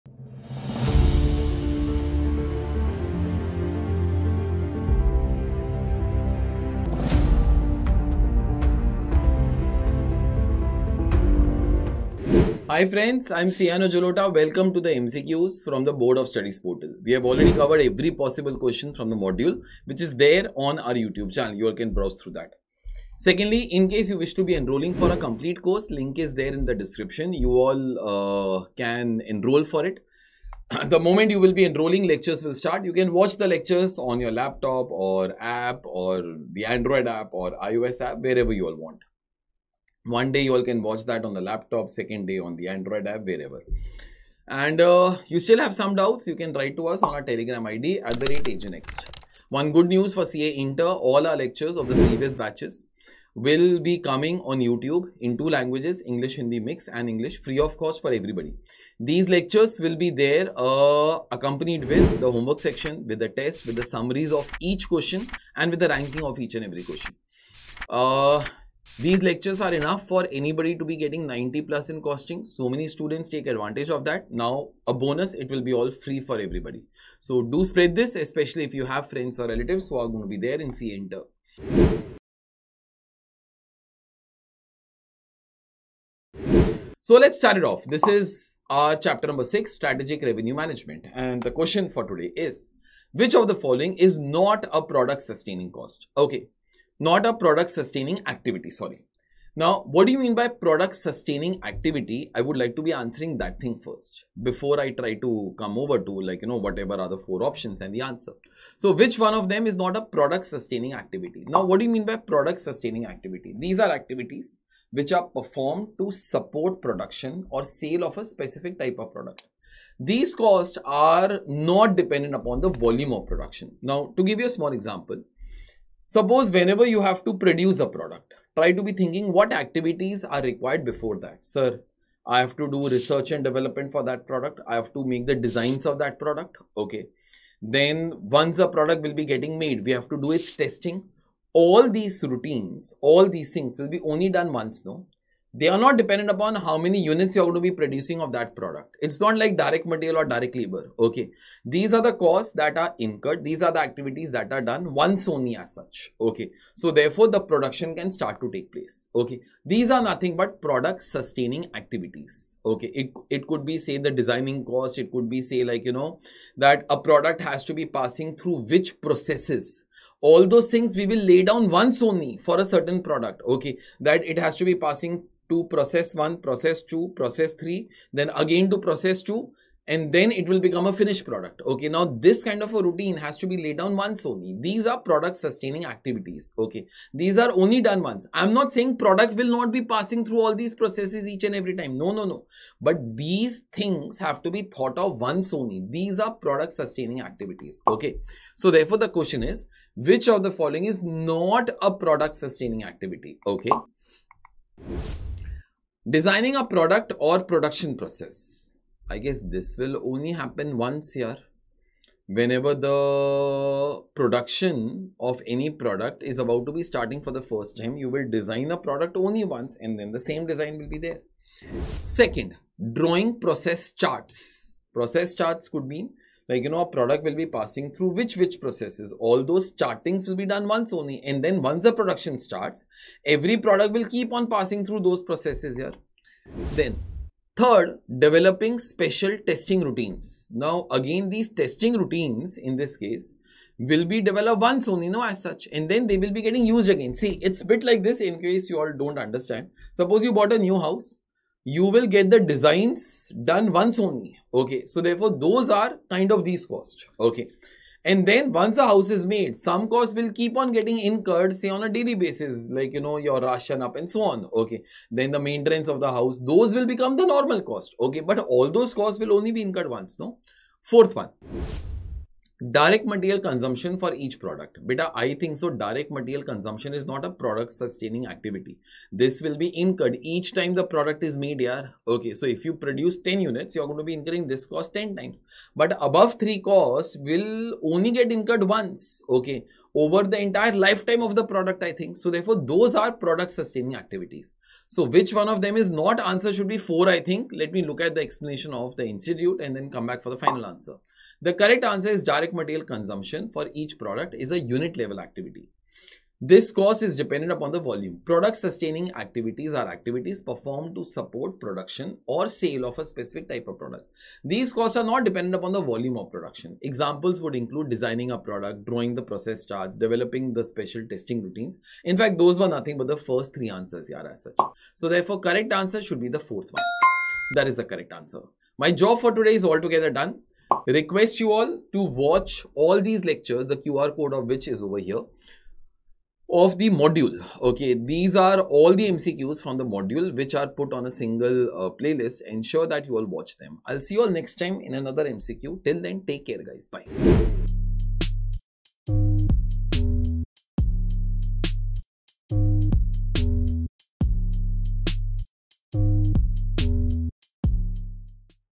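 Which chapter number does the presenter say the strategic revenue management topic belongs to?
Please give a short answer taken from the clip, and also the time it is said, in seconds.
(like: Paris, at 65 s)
6, at 88 s.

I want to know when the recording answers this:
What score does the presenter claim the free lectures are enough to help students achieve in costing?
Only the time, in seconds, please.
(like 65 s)
71 s.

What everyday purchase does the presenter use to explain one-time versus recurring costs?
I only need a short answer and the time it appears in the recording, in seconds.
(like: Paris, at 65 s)
A new house, at 250 s.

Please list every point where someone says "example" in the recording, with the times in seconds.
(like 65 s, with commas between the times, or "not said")
124 s, 316 s.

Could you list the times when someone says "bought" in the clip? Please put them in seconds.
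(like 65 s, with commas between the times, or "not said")
250 s.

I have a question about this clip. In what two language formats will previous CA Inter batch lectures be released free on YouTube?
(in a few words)
English Hindi mix and English.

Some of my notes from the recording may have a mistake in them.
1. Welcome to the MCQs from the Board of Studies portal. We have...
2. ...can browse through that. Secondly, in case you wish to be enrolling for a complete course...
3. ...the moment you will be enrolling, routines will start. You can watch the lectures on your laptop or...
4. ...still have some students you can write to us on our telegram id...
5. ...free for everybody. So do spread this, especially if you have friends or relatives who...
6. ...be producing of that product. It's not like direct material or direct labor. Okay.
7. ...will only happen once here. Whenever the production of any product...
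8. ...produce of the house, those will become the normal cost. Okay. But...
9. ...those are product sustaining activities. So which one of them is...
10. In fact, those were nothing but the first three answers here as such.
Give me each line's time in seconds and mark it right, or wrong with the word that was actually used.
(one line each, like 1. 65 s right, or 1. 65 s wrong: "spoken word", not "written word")
1. 14 s right
2. 21 s right
3. 30 s wrong: "lectures", not "routines"
4. 45 s wrong: "doubts", not "students"
5. 75 s right
6. 147 s right
7. 209 s right
8. 265 s wrong: "maintenance", not "produce"
9. 292 s right
10. 322 s right.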